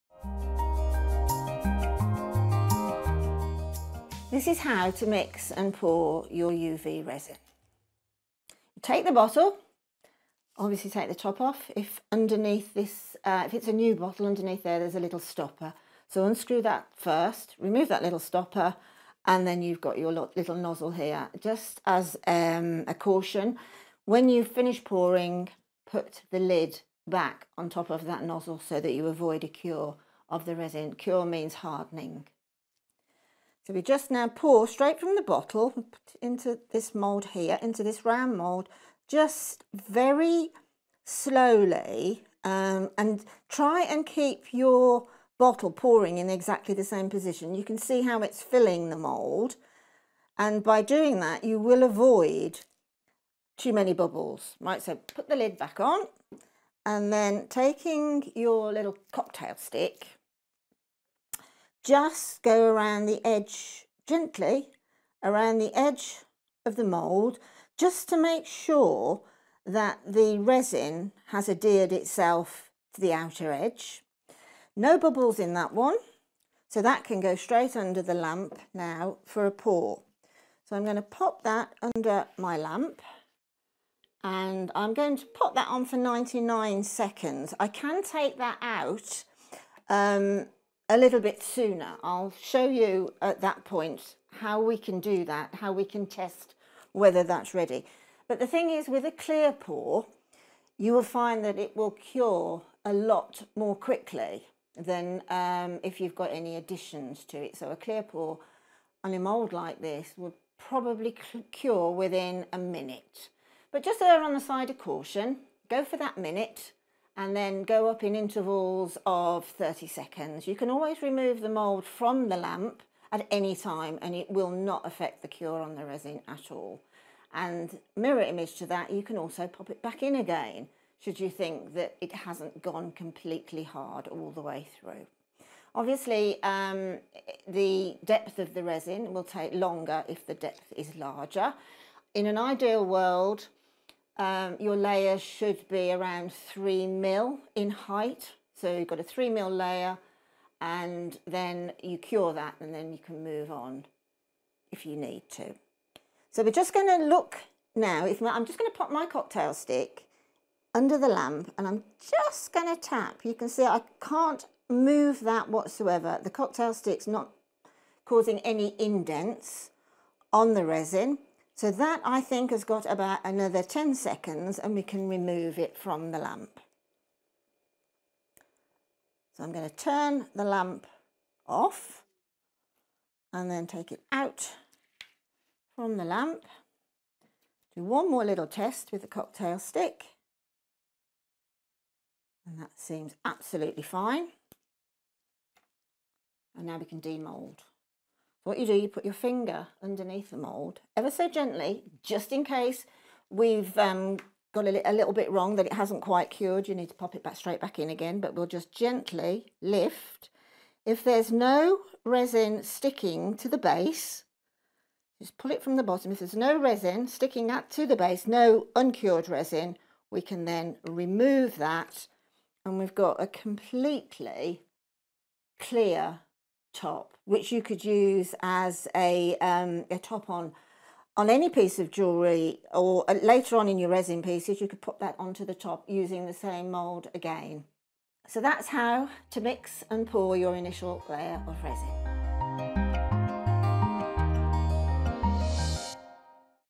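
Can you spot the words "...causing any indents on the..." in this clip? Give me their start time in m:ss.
2:48.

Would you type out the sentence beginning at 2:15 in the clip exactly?
Obviously, um, the depth of the resin will take longer if the depth is larger.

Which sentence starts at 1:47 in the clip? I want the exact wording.
So a clear pour on a mould like this would probably cure within a minute.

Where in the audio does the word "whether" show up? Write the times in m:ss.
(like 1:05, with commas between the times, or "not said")
1:36.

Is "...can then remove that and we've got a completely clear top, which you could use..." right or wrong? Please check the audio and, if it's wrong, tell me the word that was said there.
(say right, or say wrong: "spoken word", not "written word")
right.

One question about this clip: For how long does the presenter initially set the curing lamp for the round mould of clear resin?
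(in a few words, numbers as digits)
99 seconds.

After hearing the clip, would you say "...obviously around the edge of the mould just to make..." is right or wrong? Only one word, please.
wrong.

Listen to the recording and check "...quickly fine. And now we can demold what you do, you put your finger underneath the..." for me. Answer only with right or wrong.
wrong.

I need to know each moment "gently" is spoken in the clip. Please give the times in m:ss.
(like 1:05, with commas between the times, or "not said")
1:04, 3:21, 3:28.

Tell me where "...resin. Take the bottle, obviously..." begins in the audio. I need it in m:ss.
0:07.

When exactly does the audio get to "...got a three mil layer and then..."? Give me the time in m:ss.
2:28.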